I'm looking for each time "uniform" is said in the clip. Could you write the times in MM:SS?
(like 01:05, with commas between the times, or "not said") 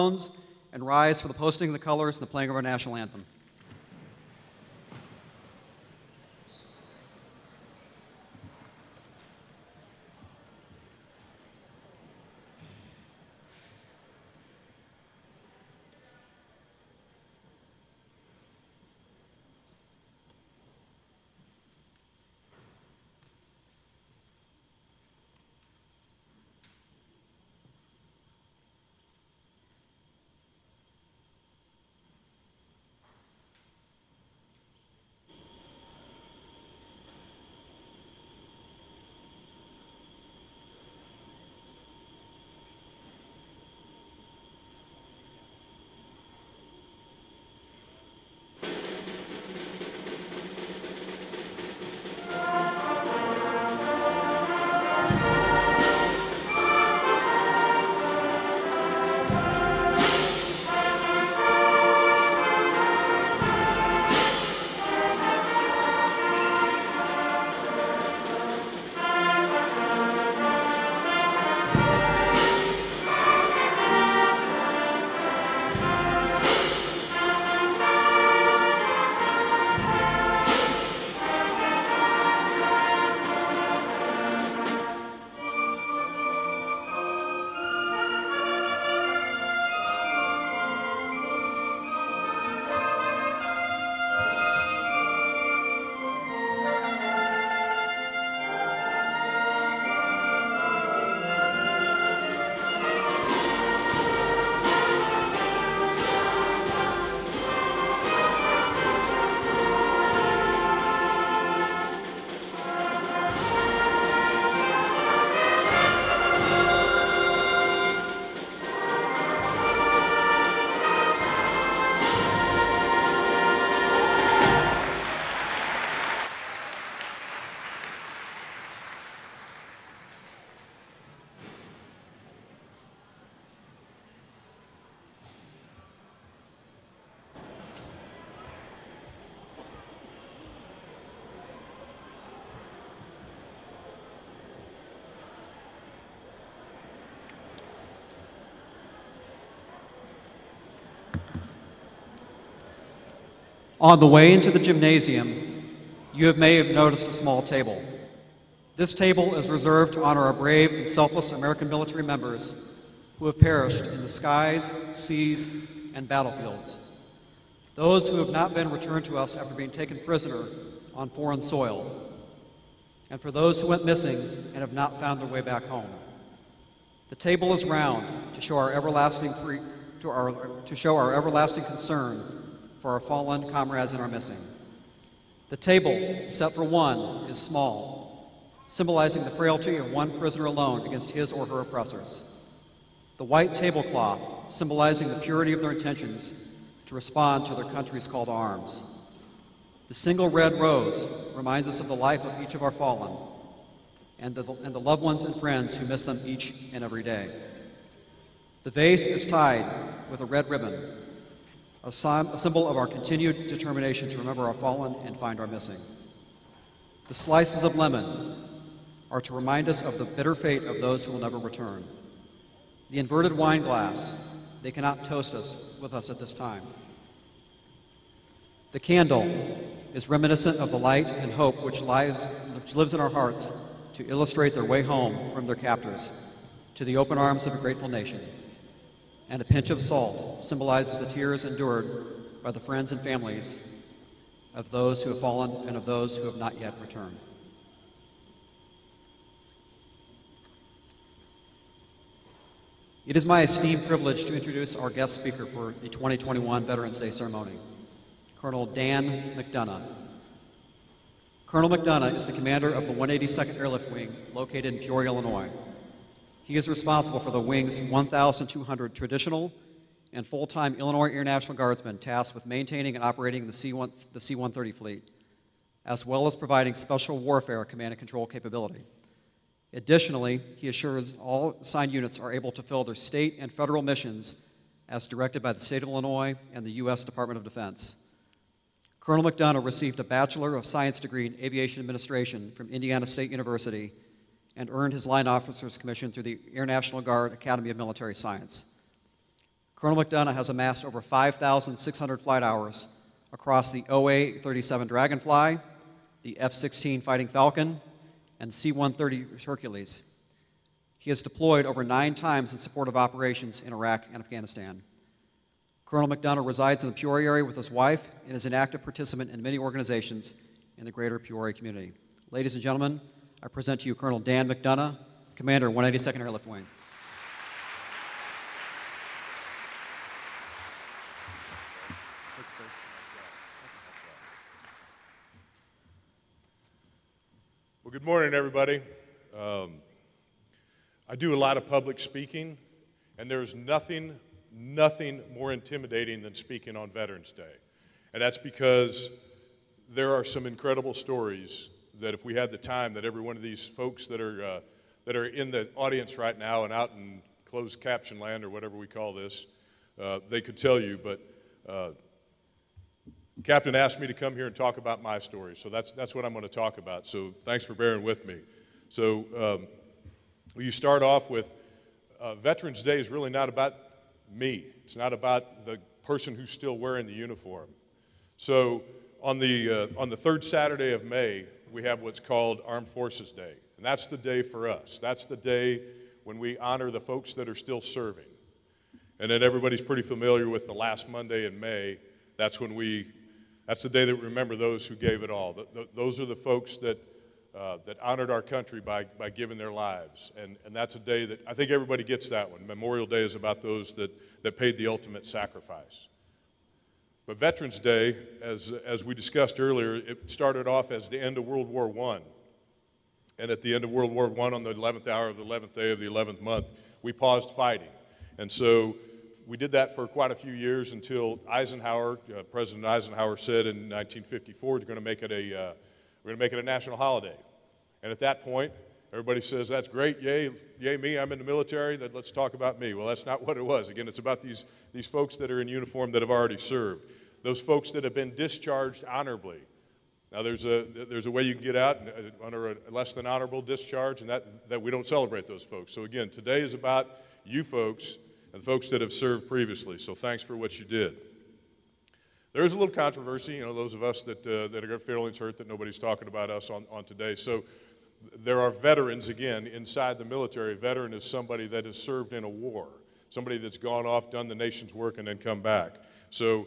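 06:17, 07:15.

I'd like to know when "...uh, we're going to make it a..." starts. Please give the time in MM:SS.
07:05.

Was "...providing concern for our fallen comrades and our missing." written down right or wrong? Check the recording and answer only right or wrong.
wrong.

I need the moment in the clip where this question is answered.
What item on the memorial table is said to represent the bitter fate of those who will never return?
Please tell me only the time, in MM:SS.
03:37.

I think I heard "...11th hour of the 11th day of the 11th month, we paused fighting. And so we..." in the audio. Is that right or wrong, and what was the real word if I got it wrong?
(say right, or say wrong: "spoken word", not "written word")
right.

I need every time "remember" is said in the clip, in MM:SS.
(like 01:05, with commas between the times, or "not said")
03:34, 06:34.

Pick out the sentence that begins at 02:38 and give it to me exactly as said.
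This table is reserved to honor our brave and selfless American military members who have perished in the skies, seas, and battlefields.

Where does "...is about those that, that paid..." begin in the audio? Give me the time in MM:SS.
06:43.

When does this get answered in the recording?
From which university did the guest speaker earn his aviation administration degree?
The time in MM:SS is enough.
04:52.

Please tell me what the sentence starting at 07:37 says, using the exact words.
So, there are veterans, again, inside the military.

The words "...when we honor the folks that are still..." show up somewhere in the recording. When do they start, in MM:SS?
06:26.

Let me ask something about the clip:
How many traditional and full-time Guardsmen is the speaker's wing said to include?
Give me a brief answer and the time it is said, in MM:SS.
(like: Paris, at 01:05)
1,200, at 04:27.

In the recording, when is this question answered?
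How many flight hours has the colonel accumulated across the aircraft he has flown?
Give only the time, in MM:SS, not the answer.
05:00.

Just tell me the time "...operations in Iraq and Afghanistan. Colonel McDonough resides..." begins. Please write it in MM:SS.
05:12.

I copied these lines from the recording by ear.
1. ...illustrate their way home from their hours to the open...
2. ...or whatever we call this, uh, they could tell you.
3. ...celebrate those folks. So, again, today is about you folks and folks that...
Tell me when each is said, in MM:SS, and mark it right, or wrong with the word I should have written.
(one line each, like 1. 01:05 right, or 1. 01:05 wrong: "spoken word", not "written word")
1. 03:54 wrong: "captors", not "hours"
2. 05:58 right
3. 07:25 right.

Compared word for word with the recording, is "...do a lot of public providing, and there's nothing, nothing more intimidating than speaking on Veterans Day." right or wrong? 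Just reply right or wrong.
wrong.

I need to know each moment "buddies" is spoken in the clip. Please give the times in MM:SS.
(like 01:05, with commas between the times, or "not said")
not said.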